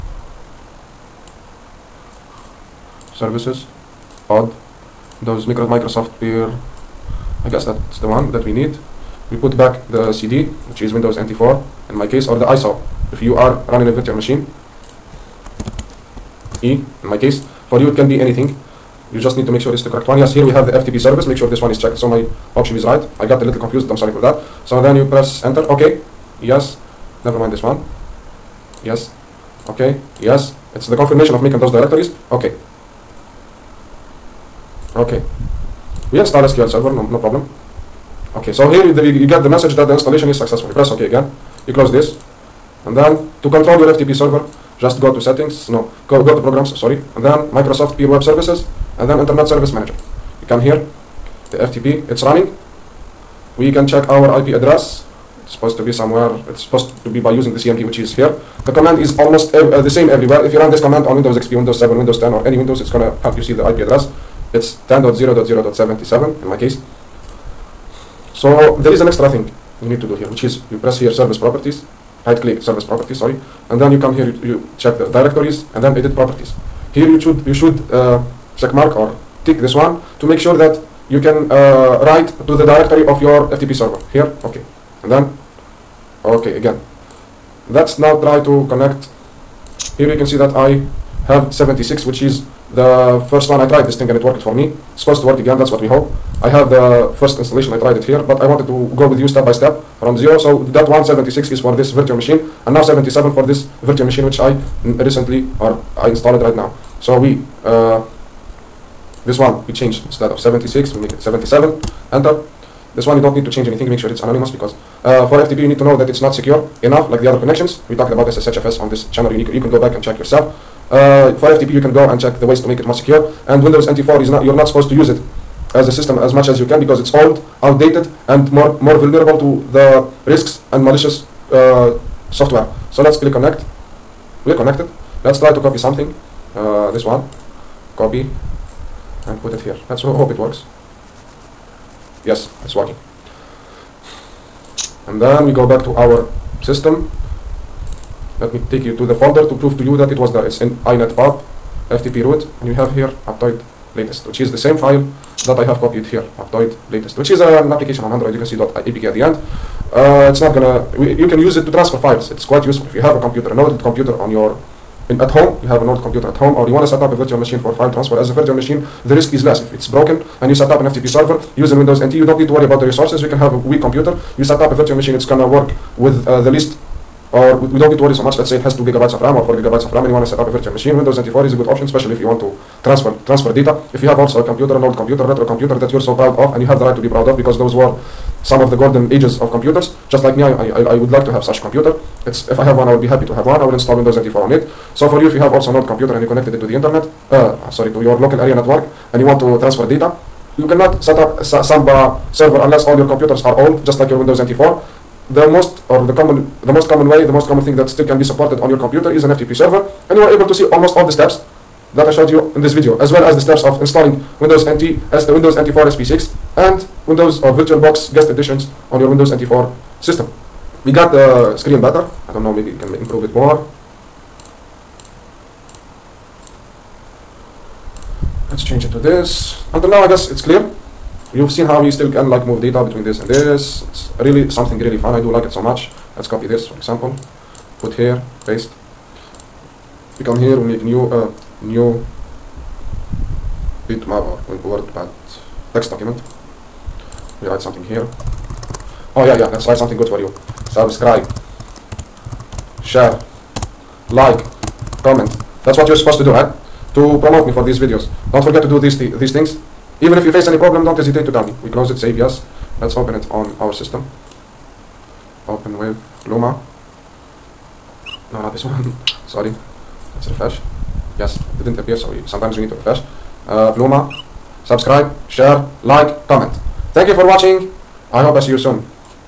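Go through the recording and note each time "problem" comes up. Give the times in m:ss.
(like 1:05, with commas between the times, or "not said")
0:37, 4:20.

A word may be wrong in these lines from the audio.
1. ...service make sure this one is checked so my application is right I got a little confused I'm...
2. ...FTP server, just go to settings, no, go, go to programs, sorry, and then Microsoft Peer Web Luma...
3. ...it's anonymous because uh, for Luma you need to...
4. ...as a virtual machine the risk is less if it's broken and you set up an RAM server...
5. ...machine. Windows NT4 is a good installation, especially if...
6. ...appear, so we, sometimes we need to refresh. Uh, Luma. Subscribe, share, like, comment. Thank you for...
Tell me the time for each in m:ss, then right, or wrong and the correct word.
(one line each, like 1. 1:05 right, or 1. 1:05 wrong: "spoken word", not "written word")
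1. 0:20 wrong: "option", not "application"
2. 0:43 wrong: "Services", not "Luma"
3. 1:54 wrong: "FTP", not "Luma"
4. 2:48 wrong: "FTP", not "RAM"
5. 3:00 wrong: "option", not "installation"
6. 4:31 right.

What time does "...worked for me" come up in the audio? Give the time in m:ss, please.
1:34.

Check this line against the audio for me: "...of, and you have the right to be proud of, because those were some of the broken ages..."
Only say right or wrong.
wrong.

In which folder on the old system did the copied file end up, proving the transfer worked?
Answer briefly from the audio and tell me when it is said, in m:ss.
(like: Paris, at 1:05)
inetpub ftp root, at 2:30.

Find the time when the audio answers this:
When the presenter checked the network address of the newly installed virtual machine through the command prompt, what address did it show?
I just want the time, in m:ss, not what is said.
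1:04.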